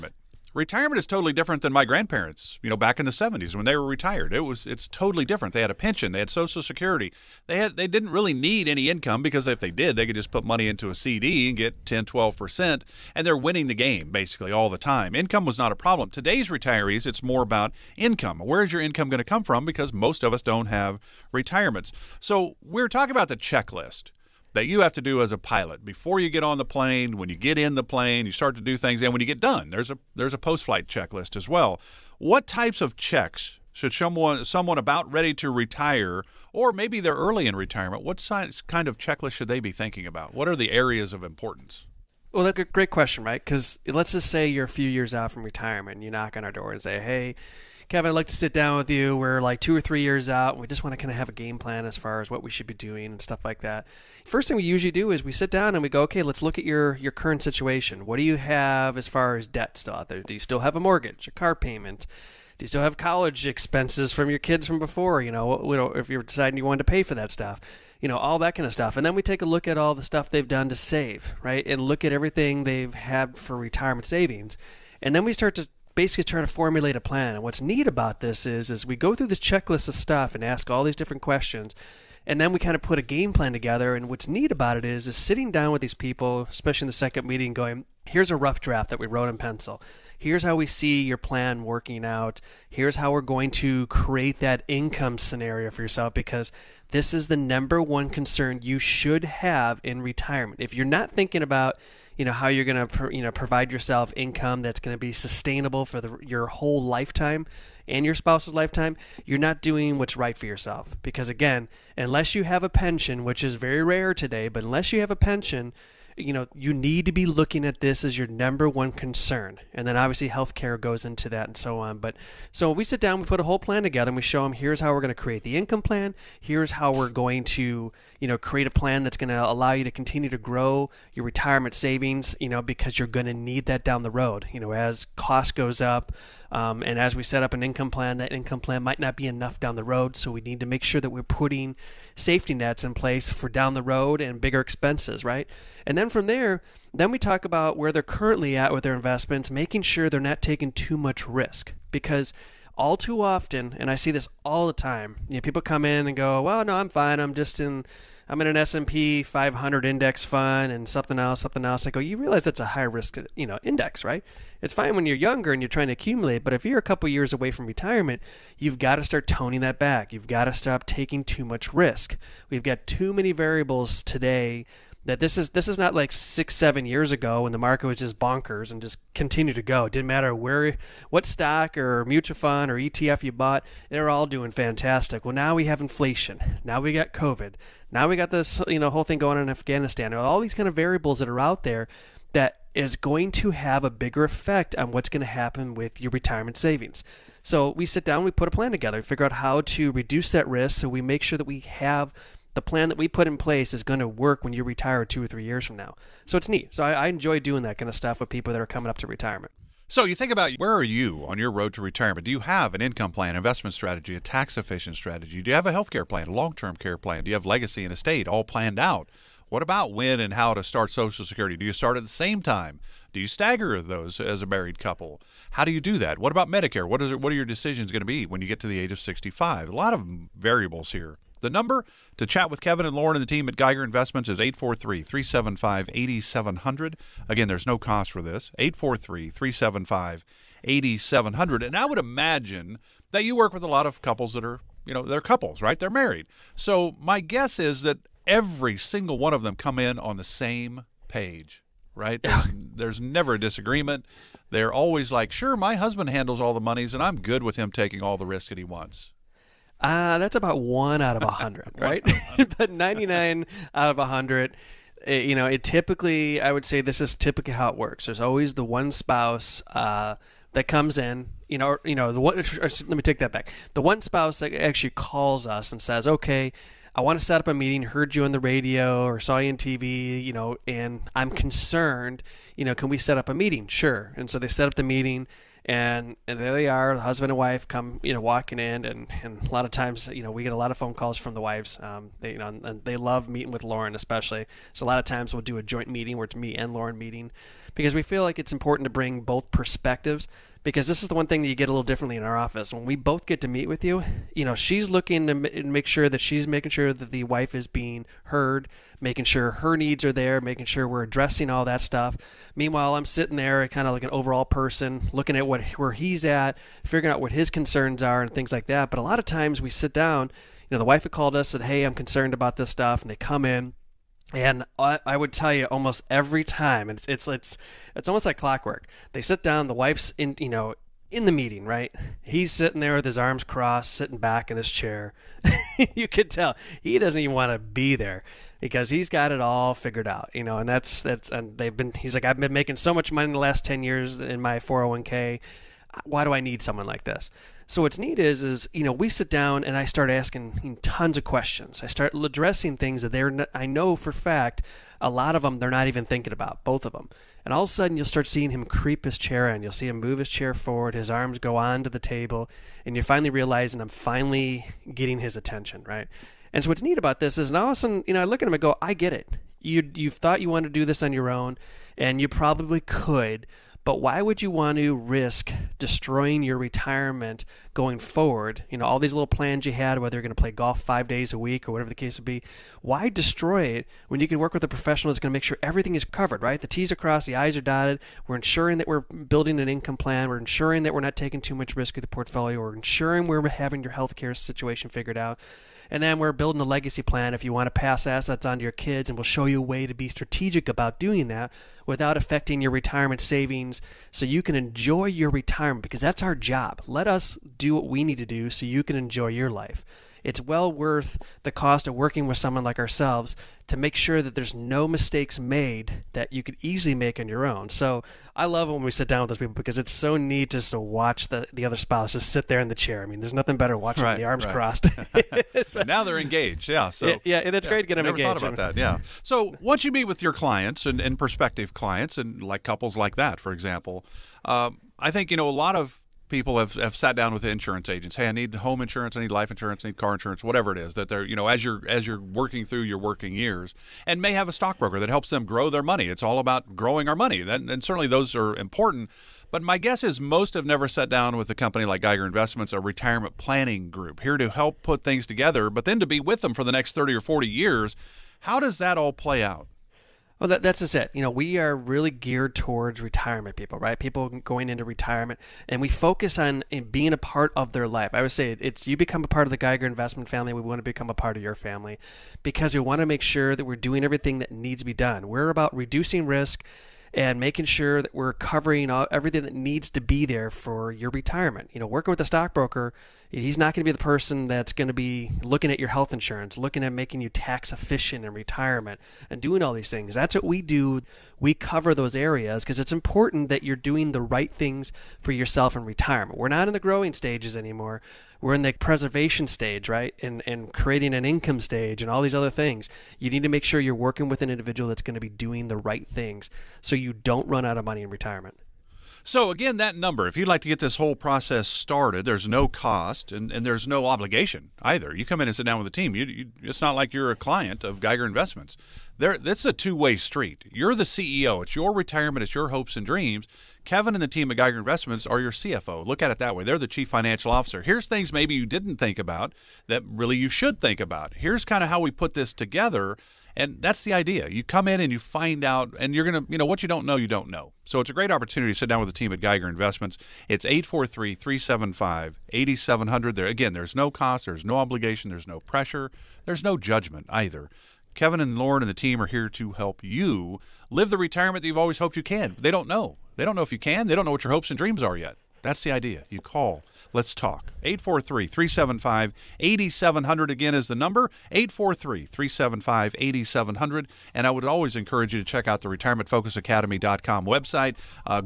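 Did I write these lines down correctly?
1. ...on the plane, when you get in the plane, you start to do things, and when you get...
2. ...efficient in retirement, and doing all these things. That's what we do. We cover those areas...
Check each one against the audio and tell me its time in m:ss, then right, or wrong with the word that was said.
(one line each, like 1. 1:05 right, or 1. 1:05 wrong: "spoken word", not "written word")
1. 0:26 right
2. 8:07 right.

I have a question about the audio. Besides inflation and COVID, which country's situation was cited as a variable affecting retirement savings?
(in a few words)
Afghanistan.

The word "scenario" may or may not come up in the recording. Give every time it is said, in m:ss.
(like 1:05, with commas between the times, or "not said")
1:35.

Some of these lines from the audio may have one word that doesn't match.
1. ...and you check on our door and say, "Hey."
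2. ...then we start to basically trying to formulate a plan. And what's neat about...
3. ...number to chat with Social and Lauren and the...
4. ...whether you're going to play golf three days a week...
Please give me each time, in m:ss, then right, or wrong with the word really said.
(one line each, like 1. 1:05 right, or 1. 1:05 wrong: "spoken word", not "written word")
1. 0:45 wrong: "knock", not "check"
2. 1:15 right
3. 3:51 wrong: "Kevin", not "Social"
4. 6:19 wrong: "five", not "three".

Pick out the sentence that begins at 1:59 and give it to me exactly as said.
And then obviously healthcare goes into that and so on.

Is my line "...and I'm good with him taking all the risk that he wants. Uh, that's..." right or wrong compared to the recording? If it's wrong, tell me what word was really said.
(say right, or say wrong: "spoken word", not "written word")
right.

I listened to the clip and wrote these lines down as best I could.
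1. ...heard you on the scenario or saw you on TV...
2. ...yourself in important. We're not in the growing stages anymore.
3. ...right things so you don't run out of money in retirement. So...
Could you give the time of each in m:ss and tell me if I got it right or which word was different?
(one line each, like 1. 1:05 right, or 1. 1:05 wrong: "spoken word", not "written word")
1. 4:37 wrong: "radio", not "scenario"
2. 8:15 wrong: "retirement", not "important"
3. 8:25 right.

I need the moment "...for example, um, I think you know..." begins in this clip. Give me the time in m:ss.
7:13.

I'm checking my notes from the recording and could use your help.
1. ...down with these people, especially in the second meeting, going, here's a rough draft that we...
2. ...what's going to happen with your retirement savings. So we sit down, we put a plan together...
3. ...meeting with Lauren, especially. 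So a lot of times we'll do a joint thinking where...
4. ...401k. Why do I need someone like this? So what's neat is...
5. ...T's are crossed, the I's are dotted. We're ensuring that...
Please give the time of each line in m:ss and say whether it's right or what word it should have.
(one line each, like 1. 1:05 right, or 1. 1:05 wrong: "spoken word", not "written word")
1. 1:25 right
2. 3:14 right
3. 4:53 wrong: "meeting", not "thinking"
4. 5:44 right
5. 6:26 right.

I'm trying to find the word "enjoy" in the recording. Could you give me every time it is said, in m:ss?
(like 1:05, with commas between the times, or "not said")
3:27, 6:44, 6:48.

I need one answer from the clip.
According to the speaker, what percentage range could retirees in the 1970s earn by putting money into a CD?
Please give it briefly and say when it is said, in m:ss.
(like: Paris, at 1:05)
10 to 12 percent, at 0:11.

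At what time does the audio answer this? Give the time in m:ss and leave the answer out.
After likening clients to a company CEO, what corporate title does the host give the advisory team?
8:45.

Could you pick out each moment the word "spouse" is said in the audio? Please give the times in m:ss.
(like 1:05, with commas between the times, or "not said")
1:48, 4:28, 4:34, 7:01.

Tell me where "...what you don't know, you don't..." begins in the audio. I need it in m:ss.
8:56.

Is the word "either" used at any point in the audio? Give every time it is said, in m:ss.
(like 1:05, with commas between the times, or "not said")
8:34, 9:07.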